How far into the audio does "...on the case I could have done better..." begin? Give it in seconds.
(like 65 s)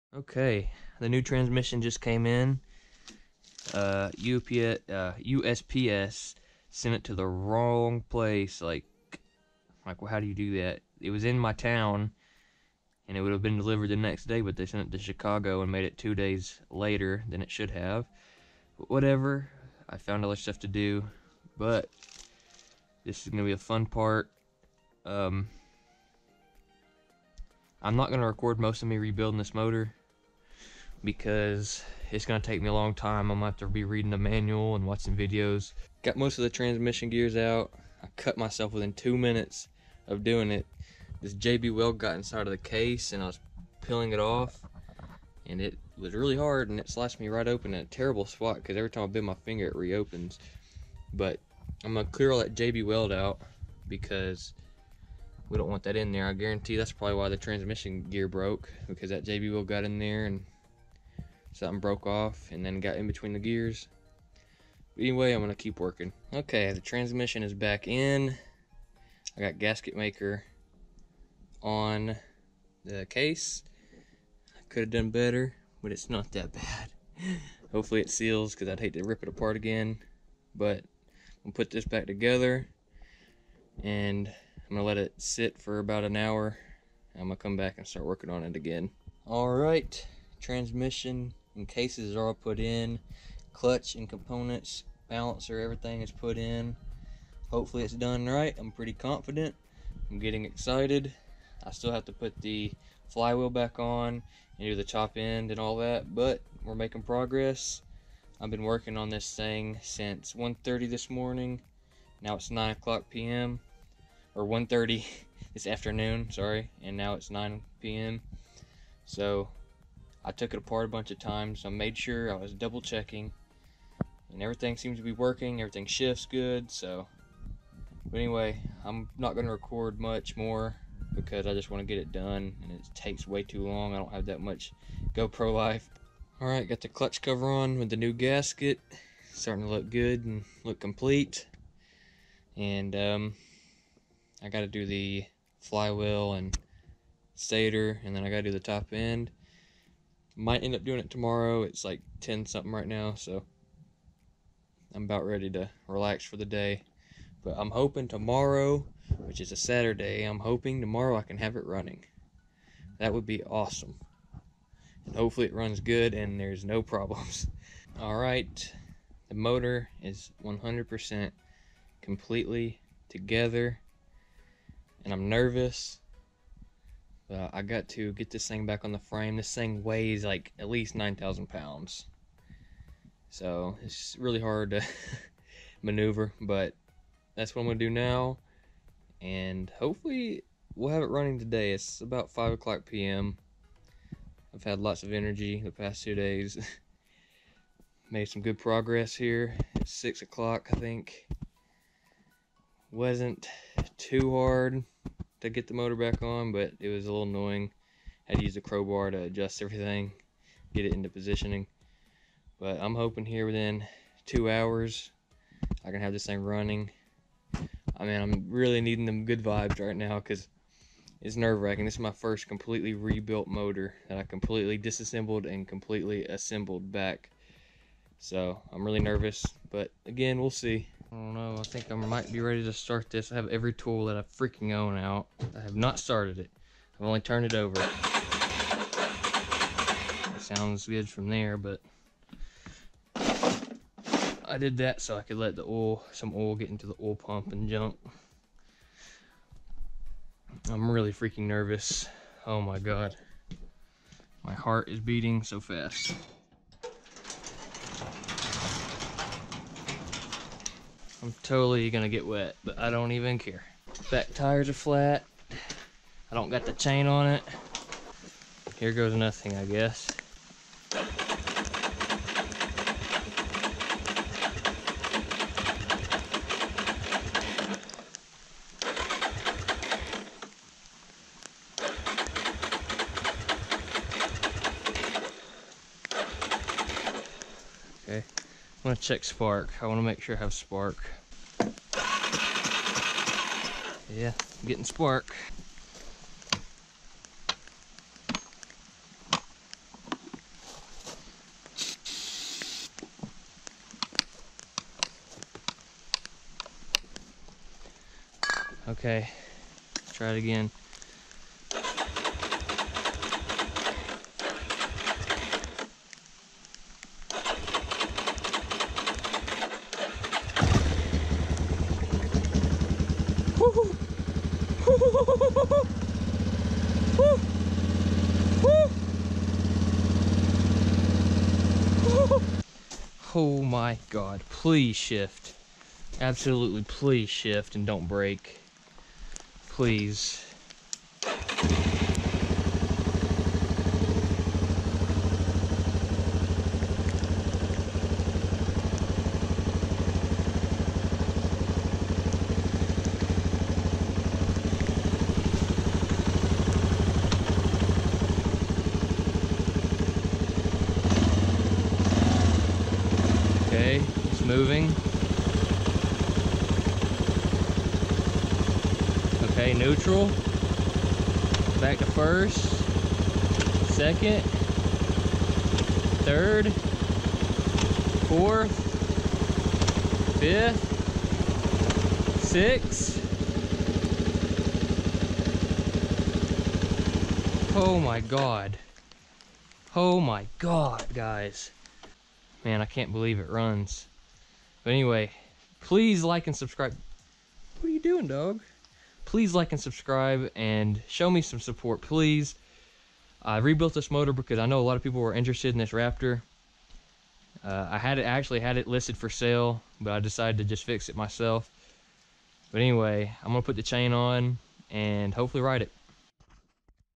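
71 s.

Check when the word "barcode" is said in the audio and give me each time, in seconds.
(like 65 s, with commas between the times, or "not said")
not said.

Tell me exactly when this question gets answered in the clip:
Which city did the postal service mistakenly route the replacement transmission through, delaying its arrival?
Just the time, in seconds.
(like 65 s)
15 s.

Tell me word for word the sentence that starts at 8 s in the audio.
Like, like, well, how do you do that?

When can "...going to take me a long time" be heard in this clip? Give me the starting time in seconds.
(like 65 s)
32 s.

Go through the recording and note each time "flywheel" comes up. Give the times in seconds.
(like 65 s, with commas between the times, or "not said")
103 s, 145 s.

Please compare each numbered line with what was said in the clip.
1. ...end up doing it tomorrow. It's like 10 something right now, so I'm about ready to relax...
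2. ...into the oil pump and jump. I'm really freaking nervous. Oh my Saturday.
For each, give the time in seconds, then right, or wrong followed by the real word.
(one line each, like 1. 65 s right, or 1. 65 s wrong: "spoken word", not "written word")
1. 150 s right
2. 246 s wrong: "God", not "Saturday".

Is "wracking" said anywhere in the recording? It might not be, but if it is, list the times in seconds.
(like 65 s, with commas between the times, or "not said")
221 s.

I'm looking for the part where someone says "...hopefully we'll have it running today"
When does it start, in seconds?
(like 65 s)
189 s.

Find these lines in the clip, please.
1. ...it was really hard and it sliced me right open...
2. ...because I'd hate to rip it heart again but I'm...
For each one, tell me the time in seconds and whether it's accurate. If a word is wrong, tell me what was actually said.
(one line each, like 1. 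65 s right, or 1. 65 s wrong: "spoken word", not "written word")
1. 45 s right
2. 78 s wrong: "apart", not "heart".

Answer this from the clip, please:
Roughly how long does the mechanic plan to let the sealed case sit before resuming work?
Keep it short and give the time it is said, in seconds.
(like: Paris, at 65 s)
An hour, at 85 s.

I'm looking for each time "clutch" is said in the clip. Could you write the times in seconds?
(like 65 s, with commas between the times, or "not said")
93 s, 136 s.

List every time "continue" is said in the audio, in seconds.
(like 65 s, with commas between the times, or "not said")
not said.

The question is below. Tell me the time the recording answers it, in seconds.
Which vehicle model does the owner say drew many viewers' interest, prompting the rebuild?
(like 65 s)
405 s.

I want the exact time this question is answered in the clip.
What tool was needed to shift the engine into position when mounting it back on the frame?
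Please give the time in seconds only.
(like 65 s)
208 s.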